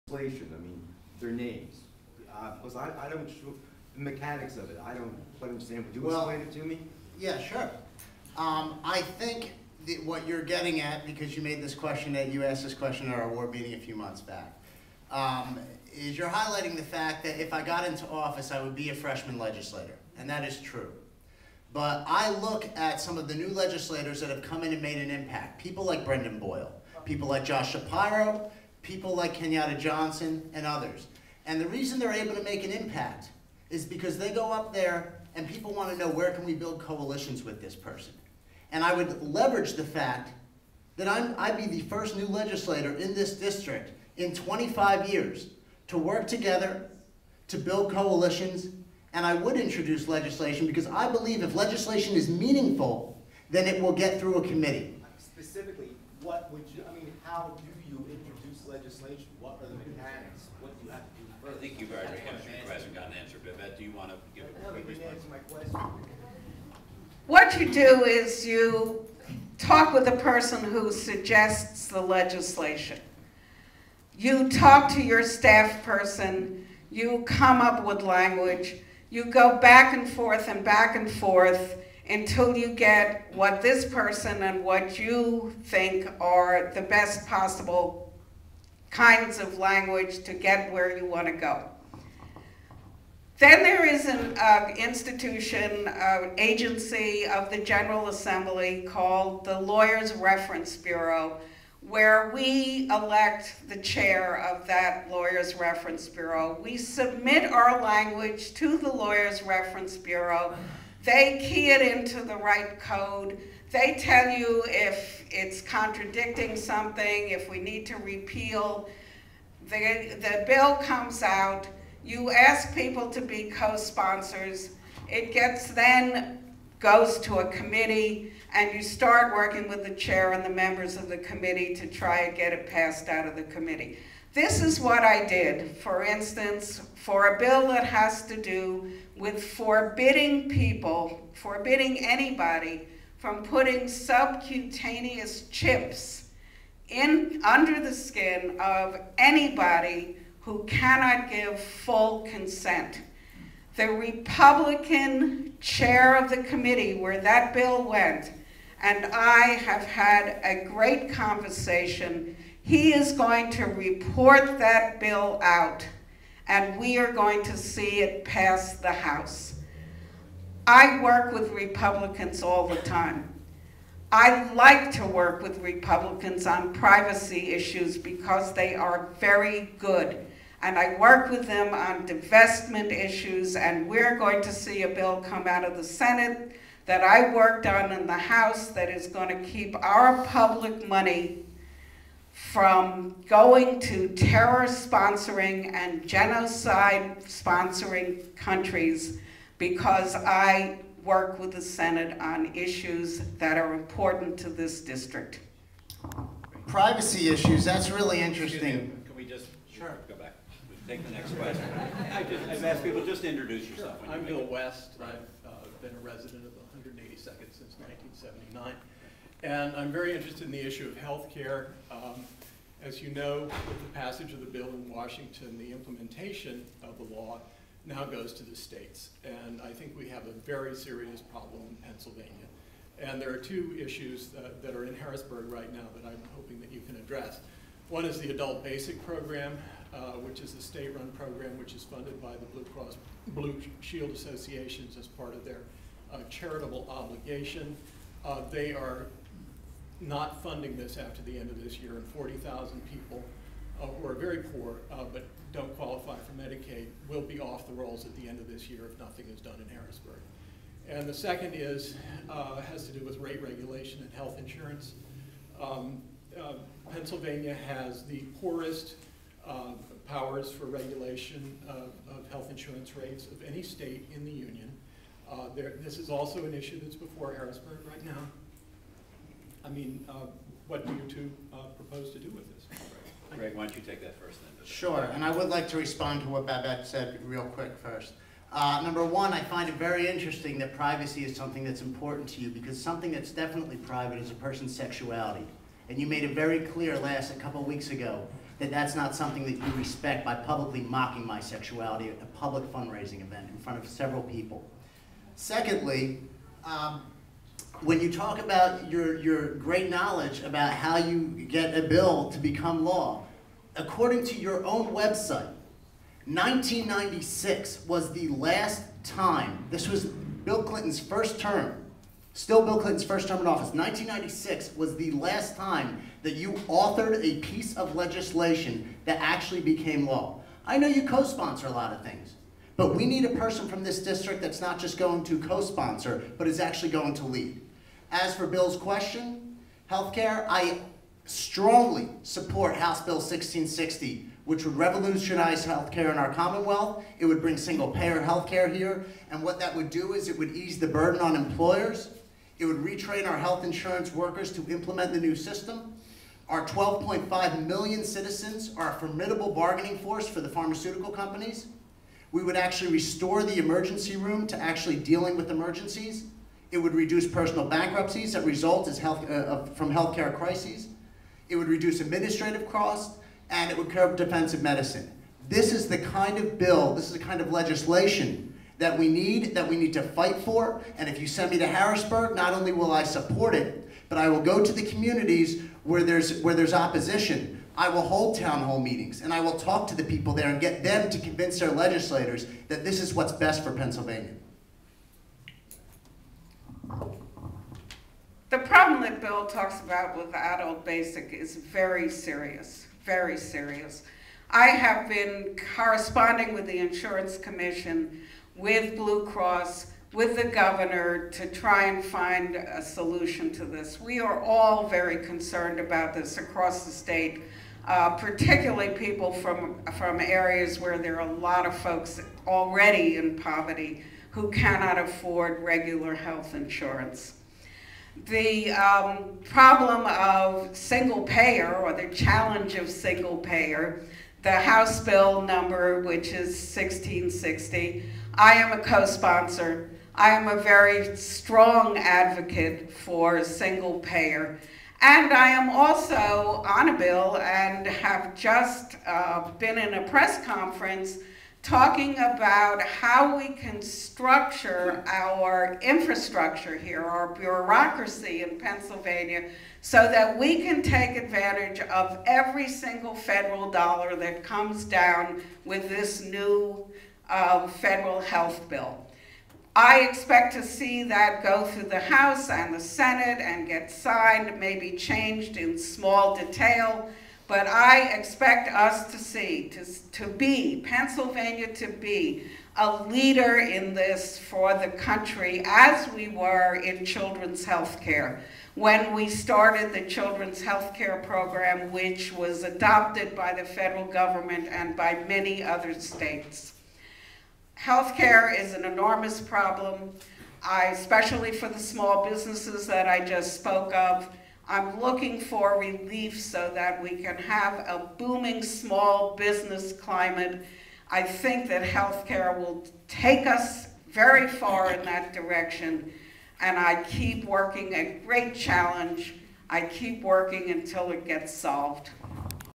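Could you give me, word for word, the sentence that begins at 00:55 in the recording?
Specifically, what would you, I mean, how do legislation, what are the mechanics, what do you have to do first?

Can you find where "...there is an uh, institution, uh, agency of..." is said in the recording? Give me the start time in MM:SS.
01:33.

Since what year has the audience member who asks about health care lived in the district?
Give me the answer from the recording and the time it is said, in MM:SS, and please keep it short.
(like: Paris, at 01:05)
1979, at 03:38.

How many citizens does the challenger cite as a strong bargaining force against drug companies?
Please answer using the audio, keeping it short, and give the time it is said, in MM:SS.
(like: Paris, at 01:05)
12.5 million, at 05:56.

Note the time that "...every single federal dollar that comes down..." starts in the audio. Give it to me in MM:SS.
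07:42.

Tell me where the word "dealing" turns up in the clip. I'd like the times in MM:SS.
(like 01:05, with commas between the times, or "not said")
06:04.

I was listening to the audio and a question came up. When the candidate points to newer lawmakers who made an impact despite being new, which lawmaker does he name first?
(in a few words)
Brendan Boyle.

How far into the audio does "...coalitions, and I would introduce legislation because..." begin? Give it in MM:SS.
00:47.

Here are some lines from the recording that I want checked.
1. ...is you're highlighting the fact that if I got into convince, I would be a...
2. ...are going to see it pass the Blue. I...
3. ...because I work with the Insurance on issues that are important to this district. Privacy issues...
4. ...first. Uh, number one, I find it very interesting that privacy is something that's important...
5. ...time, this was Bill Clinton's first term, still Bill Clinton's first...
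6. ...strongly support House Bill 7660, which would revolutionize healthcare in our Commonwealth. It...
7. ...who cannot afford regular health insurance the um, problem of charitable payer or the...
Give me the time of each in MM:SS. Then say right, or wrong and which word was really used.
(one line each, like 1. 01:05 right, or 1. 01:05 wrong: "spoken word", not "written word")
1. 00:15 wrong: "office", not "convince"
2. 02:46 wrong: "House", not "Blue"
3. 03:19 wrong: "Senate", not "Insurance"
4. 04:47 right
5. 05:19 right
6. 05:41 wrong: "1660", not "7660"
7. 07:04 wrong: "single", not "charitable".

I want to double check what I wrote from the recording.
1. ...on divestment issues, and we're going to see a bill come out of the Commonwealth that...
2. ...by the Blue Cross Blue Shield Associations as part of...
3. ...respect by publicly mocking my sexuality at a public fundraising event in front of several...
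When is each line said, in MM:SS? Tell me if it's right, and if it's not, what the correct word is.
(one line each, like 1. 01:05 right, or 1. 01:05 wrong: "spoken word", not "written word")
1. 03:01 wrong: "Senate", not "Commonwealth"
2. 04:02 right
3. 04:59 right.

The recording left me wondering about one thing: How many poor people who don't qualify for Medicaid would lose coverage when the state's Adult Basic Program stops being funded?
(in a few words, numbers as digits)
40,000.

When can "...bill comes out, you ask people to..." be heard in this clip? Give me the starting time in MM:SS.
02:00.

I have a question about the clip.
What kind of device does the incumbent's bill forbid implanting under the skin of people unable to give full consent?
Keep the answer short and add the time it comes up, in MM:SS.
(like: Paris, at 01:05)
subcutaneous chips, at 02:23.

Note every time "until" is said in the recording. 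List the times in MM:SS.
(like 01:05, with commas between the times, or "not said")
01:22, 08:40.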